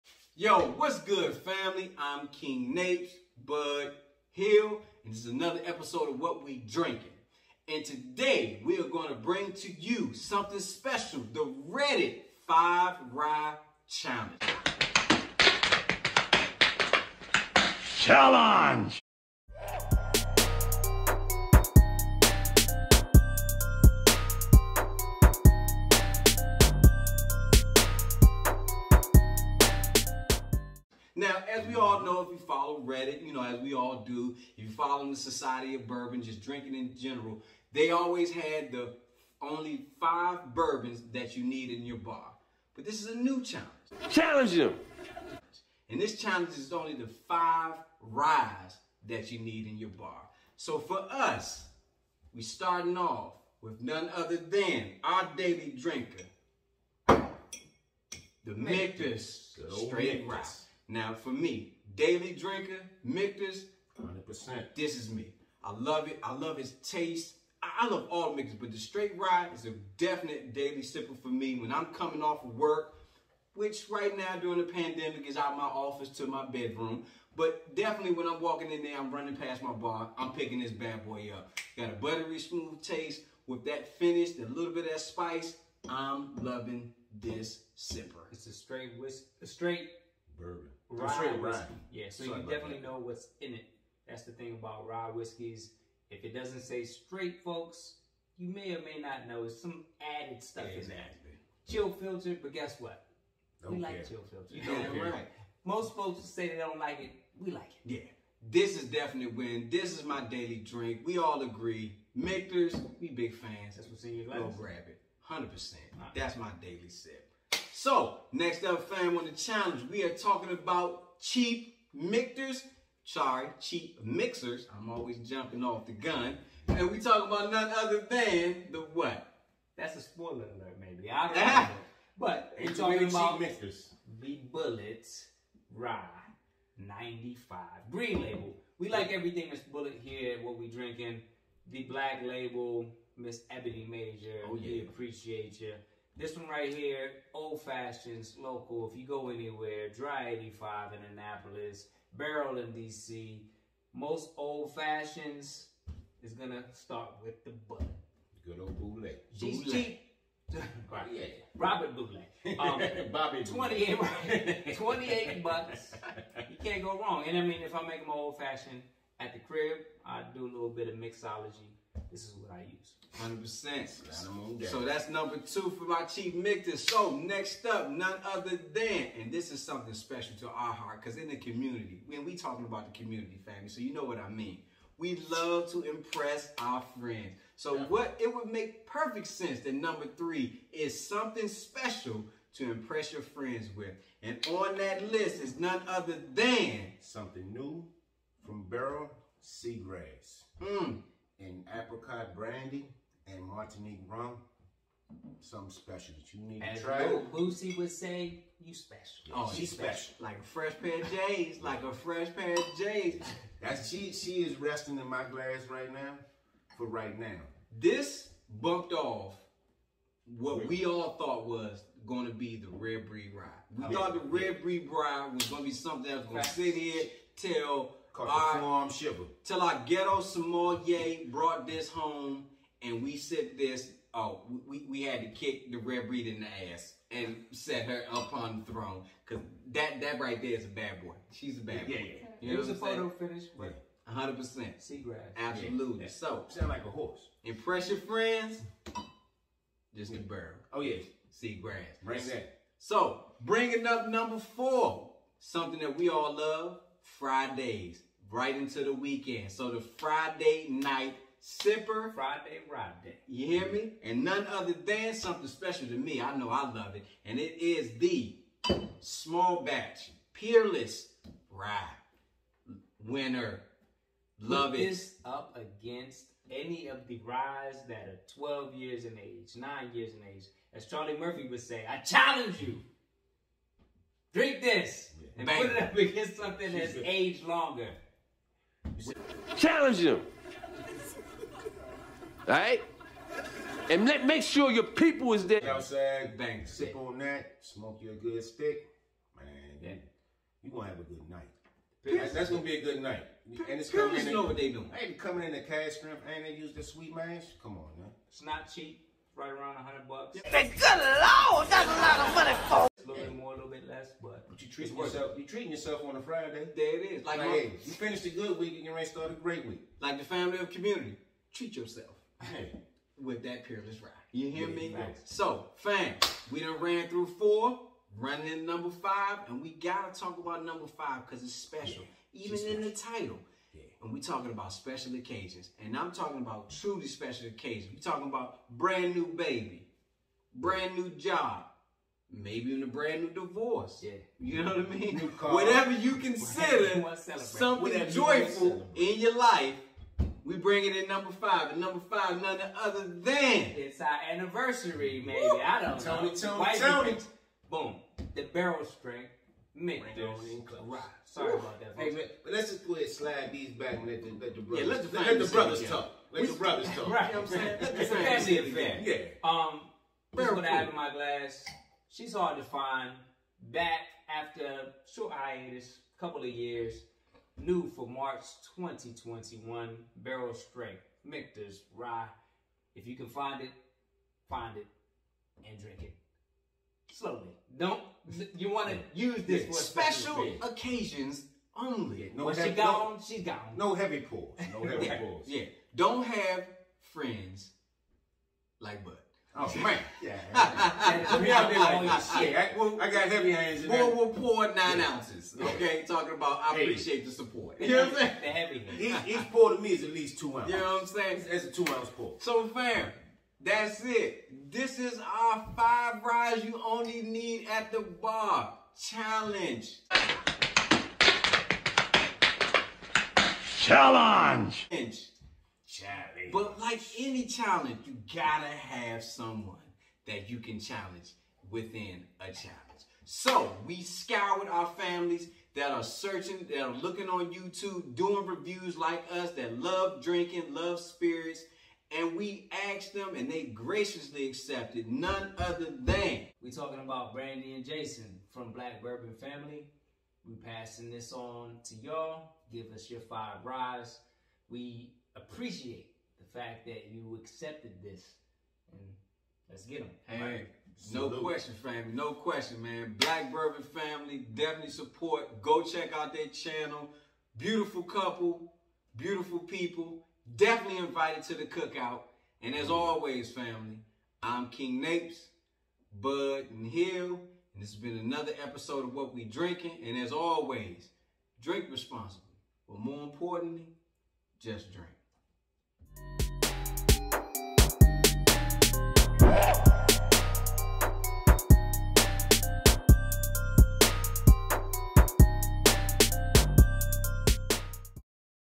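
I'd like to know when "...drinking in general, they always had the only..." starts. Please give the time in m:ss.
0:36.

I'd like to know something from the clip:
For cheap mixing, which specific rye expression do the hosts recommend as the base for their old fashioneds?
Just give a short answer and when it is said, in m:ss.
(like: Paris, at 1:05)
Bulleit Rye 95, at 2:14.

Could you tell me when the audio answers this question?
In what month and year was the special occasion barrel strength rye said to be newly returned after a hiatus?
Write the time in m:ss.
6:18.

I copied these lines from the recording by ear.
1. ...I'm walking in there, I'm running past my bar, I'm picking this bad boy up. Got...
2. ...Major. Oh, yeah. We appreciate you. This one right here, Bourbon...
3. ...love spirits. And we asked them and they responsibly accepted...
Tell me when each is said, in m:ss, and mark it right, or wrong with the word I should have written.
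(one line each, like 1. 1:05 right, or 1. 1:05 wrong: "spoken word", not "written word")
1. 1:18 right
2. 2:23 wrong: "Old", not "Bourbon"
3. 7:20 wrong: "graciously", not "responsibly".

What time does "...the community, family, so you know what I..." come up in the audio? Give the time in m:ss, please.
3:02.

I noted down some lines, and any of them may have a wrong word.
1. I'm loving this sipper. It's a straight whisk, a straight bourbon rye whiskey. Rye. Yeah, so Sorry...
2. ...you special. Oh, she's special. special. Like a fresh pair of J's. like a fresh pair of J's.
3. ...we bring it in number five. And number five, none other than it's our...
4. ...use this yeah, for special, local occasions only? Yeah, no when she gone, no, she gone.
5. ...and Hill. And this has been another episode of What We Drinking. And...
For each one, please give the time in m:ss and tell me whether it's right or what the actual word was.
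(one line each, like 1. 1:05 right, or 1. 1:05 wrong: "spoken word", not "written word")
1. 1:25 right
2. 3:28 right
3. 5:50 right
4. 6:29 wrong: "special", not "local"
5. 7:56 right.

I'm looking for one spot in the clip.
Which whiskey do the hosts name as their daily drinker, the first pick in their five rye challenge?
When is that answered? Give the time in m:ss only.
0:58.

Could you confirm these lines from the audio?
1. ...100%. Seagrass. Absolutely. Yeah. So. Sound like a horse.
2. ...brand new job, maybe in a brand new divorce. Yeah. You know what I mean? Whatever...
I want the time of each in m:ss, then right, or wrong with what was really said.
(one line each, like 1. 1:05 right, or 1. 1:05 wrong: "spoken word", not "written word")
1. 4:04 right
2. 5:40 right.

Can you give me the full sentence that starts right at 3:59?
Cause that that right there is a bad boy.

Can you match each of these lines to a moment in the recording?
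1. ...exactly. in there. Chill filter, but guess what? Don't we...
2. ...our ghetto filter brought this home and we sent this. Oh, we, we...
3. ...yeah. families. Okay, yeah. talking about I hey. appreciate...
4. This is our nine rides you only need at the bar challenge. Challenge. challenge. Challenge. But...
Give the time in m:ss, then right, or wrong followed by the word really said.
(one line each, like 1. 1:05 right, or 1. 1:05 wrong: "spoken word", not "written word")
1. 1:40 right
2. 3:49 wrong: "sommelier", not "filter"
3. 6:44 wrong: "ounces", not "families"
4. 6:54 wrong: "five", not "nine".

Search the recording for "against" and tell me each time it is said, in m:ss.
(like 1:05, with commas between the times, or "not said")
4:35, 4:45.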